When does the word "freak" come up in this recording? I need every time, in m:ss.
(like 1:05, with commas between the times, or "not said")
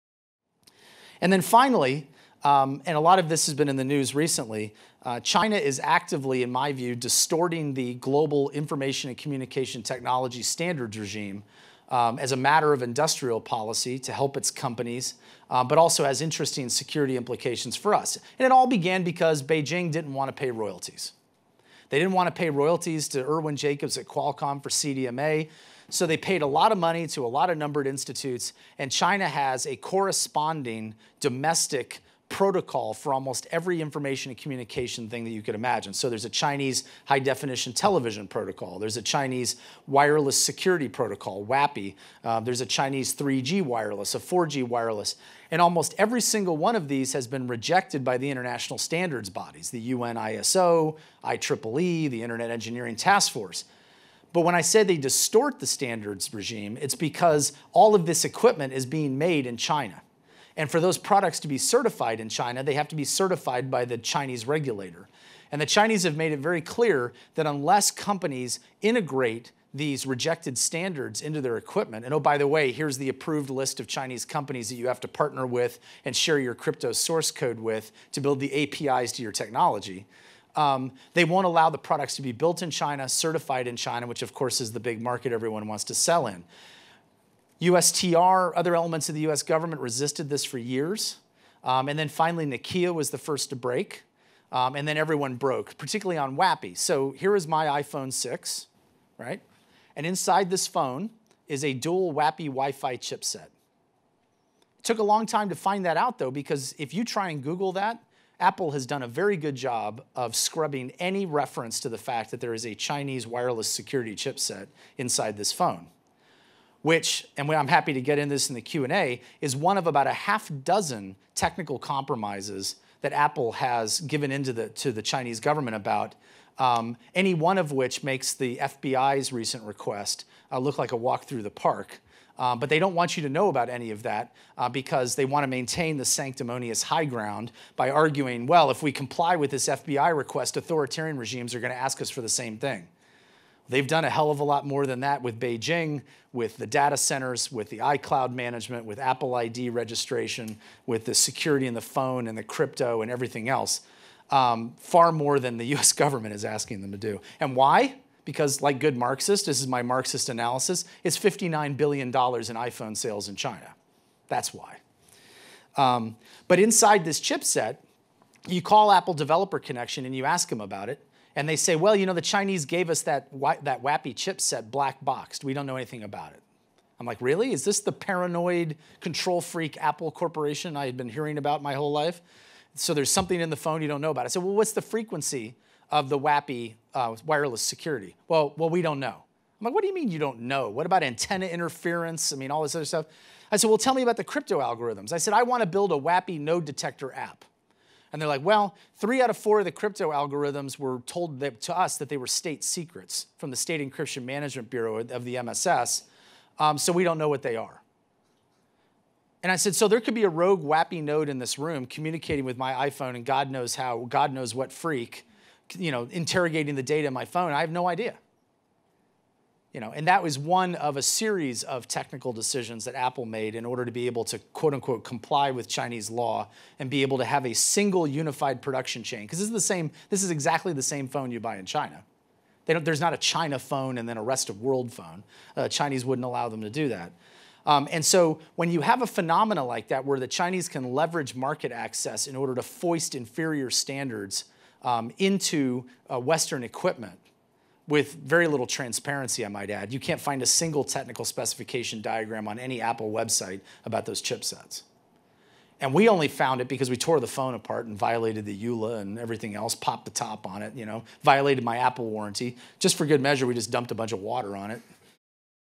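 2:59, 3:34.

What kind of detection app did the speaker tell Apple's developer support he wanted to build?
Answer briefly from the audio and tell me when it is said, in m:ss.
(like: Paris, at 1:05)
WAPI node detector, at 3:15.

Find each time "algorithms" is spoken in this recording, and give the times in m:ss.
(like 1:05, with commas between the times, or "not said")
3:14, 3:20.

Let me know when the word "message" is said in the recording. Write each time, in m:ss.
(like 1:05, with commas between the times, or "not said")
not said.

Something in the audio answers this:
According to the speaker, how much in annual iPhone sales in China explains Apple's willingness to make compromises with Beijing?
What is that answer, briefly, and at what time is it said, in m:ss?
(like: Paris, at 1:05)
$59 billion, at 2:41.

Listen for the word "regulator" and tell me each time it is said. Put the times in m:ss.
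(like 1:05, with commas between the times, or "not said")
1:04.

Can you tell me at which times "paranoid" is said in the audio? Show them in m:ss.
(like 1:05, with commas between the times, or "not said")
2:57.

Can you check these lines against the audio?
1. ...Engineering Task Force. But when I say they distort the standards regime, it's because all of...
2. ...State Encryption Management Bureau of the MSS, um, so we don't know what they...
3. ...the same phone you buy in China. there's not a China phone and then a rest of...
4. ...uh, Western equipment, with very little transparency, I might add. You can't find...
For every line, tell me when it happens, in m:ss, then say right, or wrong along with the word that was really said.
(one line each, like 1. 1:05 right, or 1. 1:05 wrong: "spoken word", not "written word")
1. 0:52 right
2. 3:23 right
3. 3:50 right
4. 4:06 right.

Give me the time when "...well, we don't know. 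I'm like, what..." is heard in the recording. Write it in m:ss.
3:08.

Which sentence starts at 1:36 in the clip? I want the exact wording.
So here is my iPhone 6, right?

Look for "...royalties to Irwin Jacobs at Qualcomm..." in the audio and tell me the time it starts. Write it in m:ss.
0:22.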